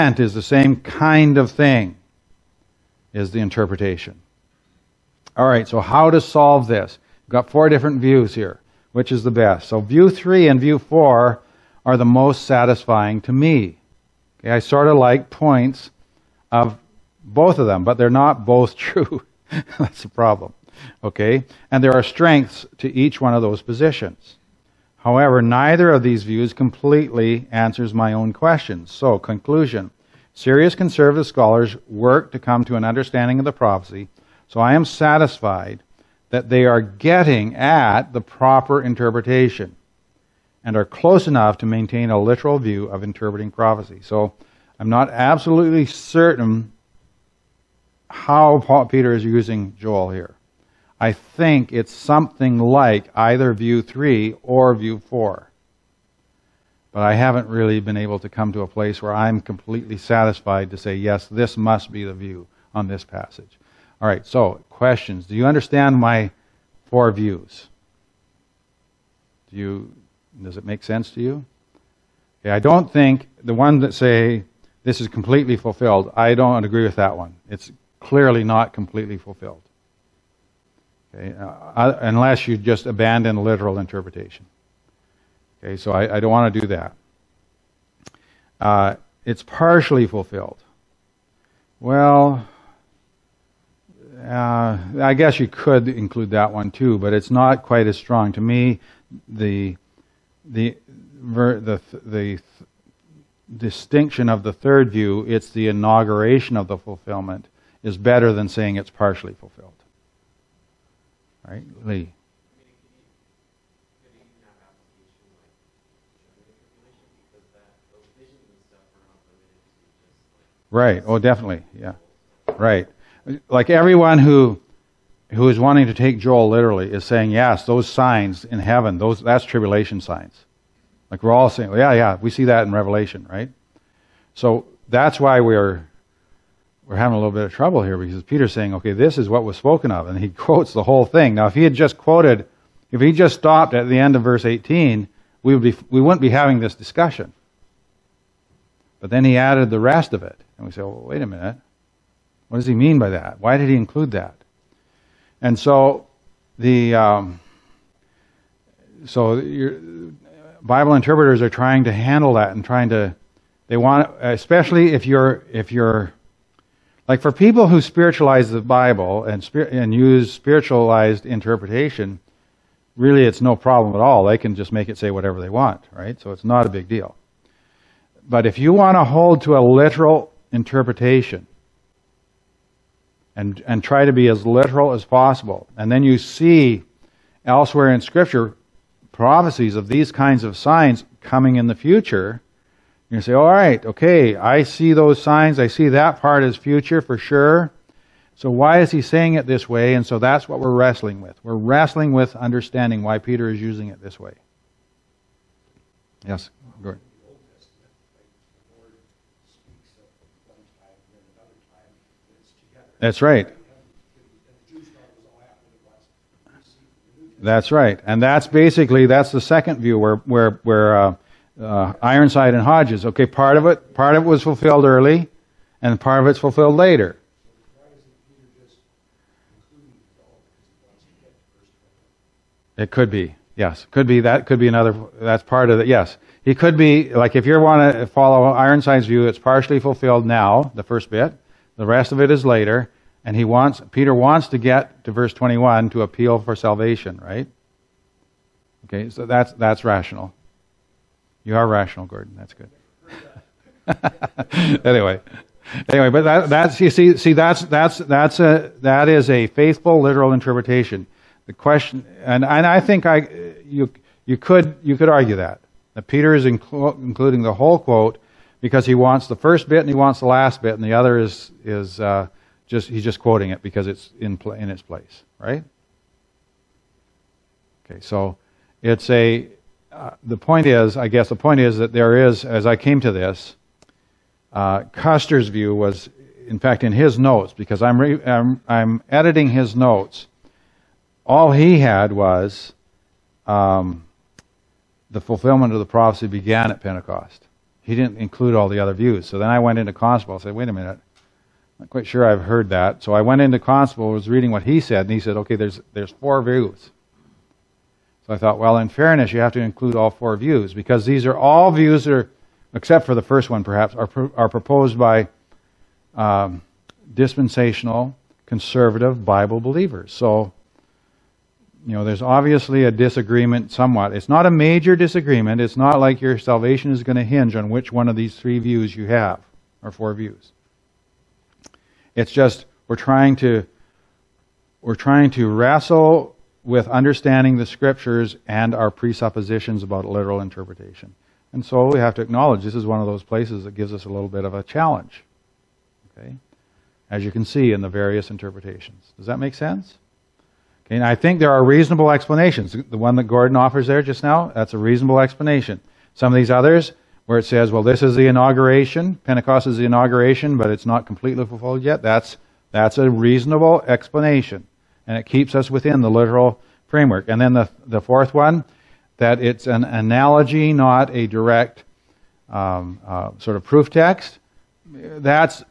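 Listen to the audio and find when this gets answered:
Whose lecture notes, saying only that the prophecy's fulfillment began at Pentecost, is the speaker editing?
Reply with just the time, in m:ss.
4:44.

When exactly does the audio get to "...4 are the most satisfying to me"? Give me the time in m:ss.
0:10.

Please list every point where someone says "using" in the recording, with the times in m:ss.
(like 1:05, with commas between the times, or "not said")
0:49, 3:23.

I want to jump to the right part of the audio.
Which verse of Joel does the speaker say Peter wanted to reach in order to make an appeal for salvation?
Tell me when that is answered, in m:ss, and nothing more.
4:05.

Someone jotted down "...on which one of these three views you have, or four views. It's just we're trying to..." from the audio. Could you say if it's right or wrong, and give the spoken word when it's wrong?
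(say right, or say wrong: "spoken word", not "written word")
right.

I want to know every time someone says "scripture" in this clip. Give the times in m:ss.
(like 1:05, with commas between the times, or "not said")
3:08, 5:37.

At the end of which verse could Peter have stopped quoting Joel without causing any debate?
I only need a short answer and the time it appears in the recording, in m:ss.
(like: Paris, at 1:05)
Verse 18, at 2:24.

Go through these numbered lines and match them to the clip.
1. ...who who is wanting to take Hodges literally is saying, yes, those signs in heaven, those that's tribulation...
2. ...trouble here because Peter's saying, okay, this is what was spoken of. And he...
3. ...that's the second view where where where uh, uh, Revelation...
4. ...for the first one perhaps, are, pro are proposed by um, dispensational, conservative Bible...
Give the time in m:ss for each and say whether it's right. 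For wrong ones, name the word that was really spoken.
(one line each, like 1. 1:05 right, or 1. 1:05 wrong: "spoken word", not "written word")
1. 2:04 wrong: "Joel", not "Hodges"
2. 2:17 right
3. 3:39 wrong: "Ironside", not "Revelation"
4. 5:13 right.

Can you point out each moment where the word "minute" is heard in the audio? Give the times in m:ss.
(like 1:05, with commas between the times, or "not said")
2:31, 5:00.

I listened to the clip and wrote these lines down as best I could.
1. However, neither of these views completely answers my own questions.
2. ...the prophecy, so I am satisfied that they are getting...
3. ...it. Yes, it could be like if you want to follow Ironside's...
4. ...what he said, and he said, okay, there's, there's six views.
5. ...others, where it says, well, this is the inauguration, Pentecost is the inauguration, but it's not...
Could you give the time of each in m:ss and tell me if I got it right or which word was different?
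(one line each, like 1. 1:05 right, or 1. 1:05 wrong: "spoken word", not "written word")
1. 0:24 right
2. 0:33 right
3. 3:55 right
4. 5:04 wrong: "four", not "six"
5. 5:56 right.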